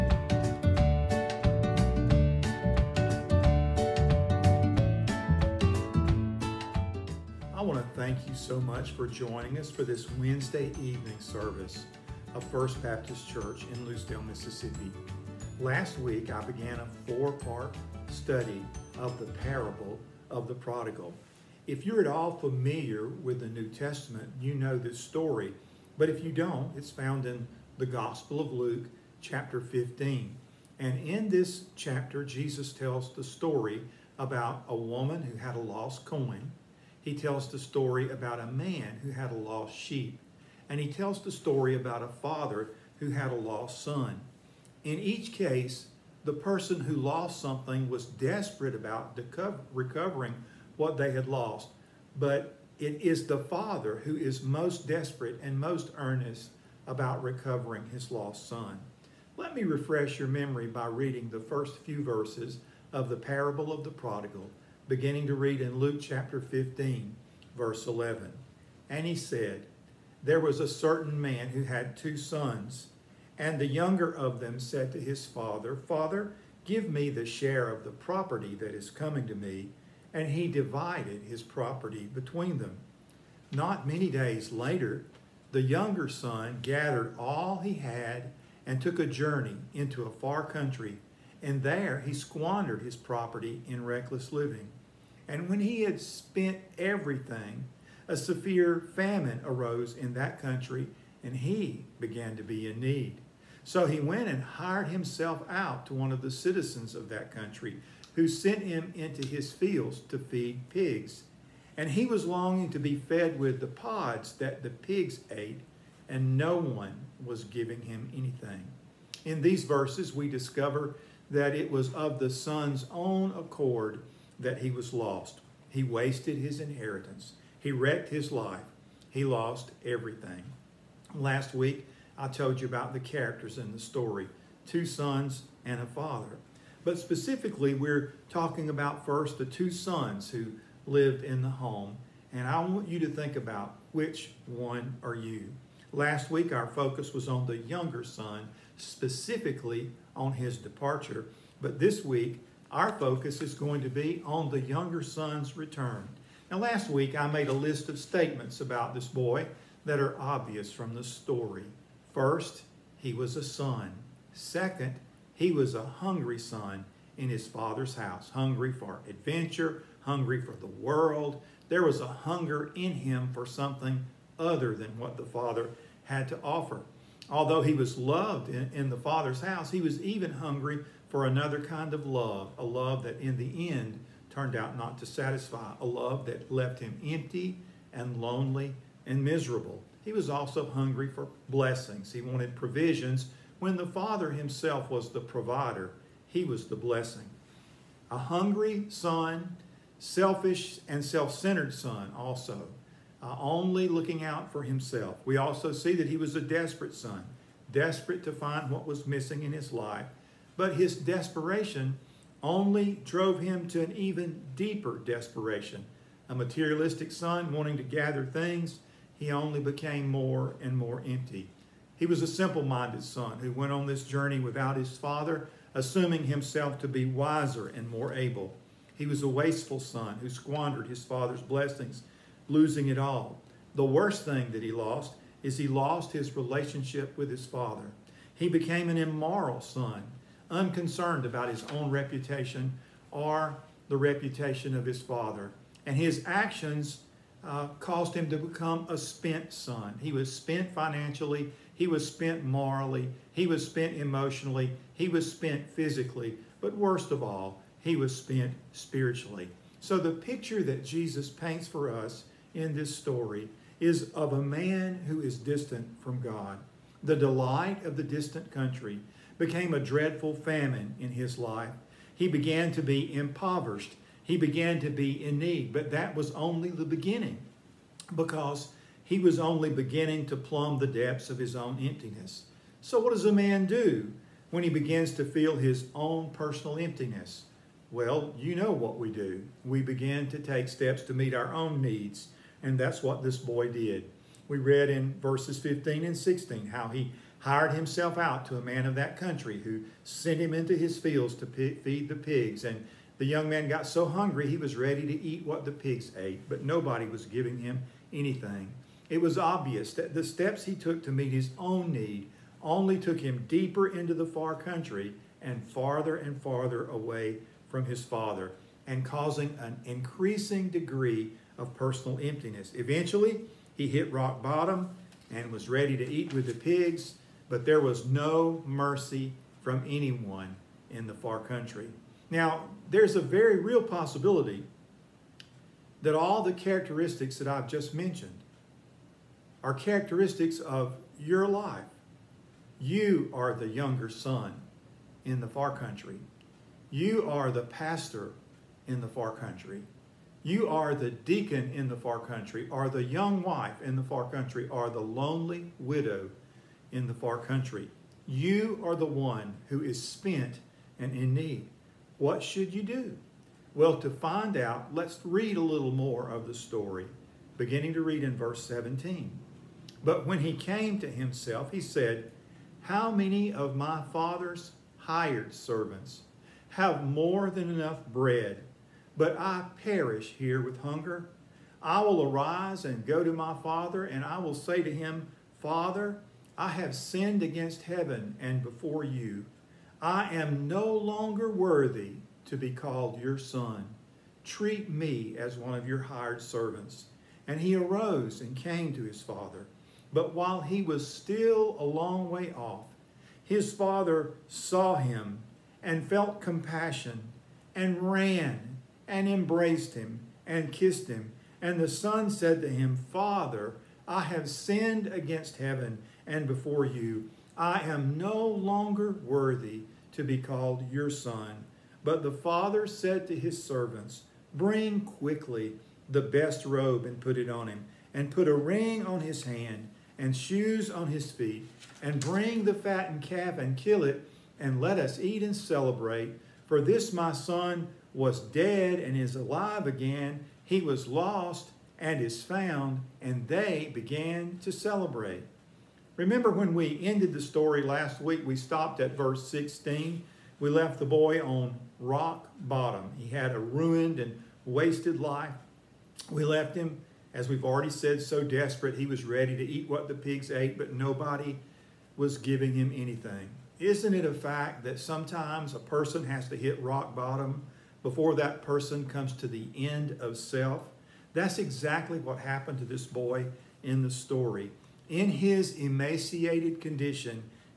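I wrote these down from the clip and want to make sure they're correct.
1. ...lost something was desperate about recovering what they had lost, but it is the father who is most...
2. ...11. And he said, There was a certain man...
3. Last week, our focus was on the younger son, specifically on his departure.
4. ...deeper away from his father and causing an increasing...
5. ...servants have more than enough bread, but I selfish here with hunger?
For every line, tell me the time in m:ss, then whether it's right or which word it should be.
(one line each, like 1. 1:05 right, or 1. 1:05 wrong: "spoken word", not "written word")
1. 0:46 right
2. 1:07 right
3. 2:25 right
4. 5:16 wrong: "farther", not "deeper"
5. 6:15 wrong: "perish", not "selfish".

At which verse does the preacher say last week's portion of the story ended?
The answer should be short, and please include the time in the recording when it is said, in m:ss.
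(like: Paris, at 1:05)
16, at 7:29.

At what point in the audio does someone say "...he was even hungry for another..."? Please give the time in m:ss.
2:59.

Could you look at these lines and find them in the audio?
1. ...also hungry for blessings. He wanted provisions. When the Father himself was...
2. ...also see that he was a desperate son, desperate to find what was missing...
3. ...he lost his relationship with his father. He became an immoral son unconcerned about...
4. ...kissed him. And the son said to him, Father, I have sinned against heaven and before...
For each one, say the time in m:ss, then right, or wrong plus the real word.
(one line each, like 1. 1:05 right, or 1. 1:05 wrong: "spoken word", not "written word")
1. 3:10 right
2. 3:25 right
3. 3:55 right
4. 6:50 right.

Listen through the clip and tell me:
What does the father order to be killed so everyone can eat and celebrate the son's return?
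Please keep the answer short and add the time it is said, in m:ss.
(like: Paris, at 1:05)
the fattened calf, at 7:12.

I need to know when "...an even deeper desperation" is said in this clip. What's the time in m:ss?
3:33.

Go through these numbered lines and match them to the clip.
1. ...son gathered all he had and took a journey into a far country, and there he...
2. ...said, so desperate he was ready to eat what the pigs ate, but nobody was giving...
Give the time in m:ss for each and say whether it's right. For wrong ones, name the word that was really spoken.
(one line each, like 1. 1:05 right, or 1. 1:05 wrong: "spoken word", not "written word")
1. 1:26 right
2. 7:37 right.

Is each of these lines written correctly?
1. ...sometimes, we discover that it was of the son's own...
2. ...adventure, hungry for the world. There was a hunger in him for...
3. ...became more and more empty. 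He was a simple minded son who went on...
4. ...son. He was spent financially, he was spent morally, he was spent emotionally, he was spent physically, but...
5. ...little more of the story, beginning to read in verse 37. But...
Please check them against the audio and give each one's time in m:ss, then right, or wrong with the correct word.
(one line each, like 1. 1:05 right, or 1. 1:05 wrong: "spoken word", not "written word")
1. 1:59 wrong: "verses", not "sometimes"
2. 2:49 right
3. 3:39 right
4. 4:09 right
5. 6:05 wrong: "17", not "37".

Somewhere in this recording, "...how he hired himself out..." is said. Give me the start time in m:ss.
4:56.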